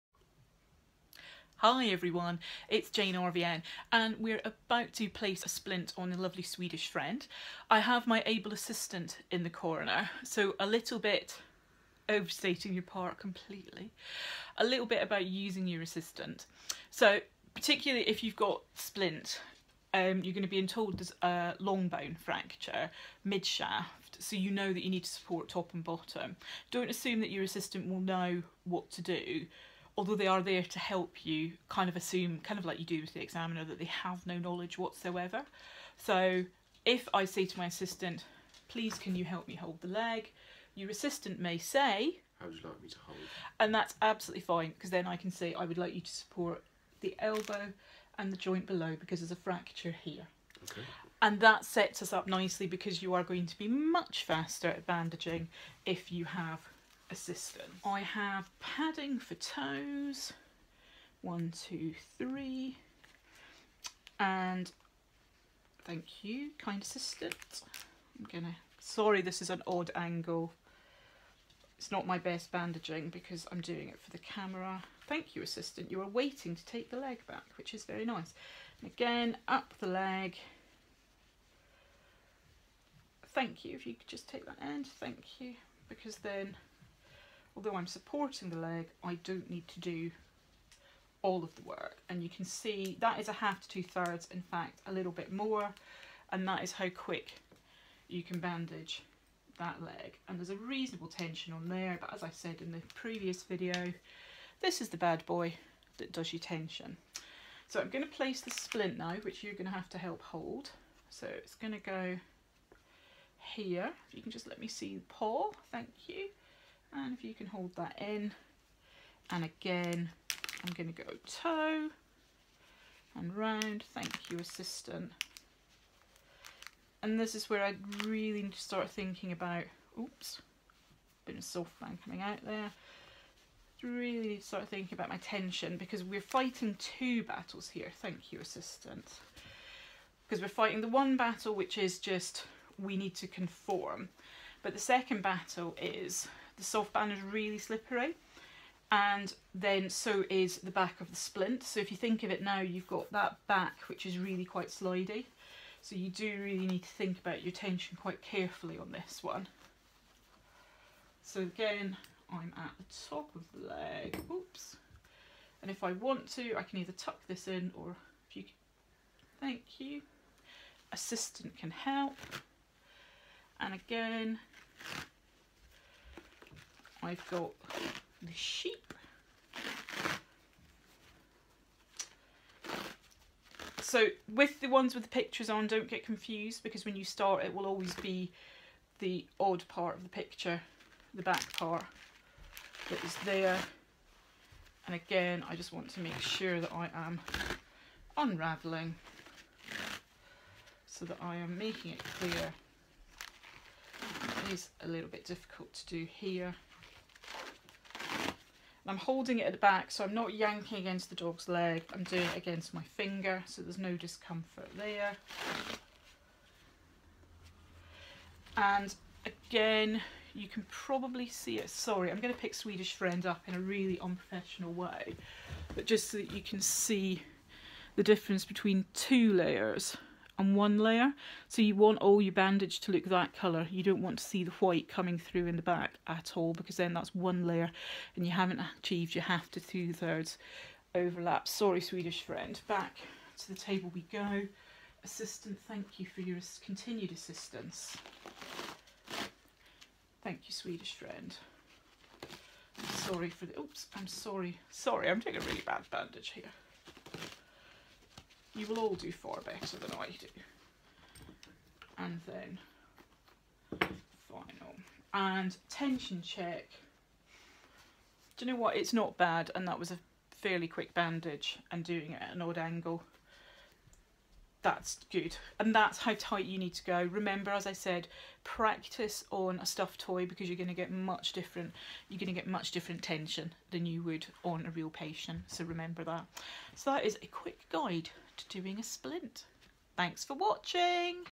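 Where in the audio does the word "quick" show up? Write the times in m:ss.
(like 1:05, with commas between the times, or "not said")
1:36, 4:30, 4:47.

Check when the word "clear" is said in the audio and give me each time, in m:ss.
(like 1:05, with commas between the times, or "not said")
3:22.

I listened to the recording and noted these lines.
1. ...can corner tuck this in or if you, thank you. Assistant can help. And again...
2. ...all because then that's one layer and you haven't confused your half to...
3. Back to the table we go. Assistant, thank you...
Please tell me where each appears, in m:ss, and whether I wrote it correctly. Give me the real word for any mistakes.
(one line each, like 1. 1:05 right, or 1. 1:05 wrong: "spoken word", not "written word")
1. 2:46 wrong: "either", not "corner"
2. 3:56 wrong: "achieved", not "confused"
3. 4:02 right.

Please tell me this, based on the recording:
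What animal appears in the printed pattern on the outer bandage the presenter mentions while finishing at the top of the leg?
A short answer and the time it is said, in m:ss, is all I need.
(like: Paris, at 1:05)
sheep, at 2:58.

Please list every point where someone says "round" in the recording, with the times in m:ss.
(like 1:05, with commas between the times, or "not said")
2:03.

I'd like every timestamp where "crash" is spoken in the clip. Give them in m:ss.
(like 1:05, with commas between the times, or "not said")
not said.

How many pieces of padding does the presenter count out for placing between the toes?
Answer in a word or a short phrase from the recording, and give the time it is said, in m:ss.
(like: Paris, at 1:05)
3, at 1:02.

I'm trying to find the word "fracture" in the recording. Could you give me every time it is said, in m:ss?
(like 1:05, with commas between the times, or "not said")
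0:22, 0:49.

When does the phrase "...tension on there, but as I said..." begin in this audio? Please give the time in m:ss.
1:41.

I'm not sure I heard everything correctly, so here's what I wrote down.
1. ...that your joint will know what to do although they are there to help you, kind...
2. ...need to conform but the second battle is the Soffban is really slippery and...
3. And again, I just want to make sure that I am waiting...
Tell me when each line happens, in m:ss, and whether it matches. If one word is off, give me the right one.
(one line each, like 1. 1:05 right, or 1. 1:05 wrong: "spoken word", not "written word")
1. 0:27 wrong: "assistant", not "joint"
2. 2:22 right
3. 3:14 wrong: "unraveling", not "waiting".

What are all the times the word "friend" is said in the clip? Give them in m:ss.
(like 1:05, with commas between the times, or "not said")
0:06, 3:42, 4:02, 4:10.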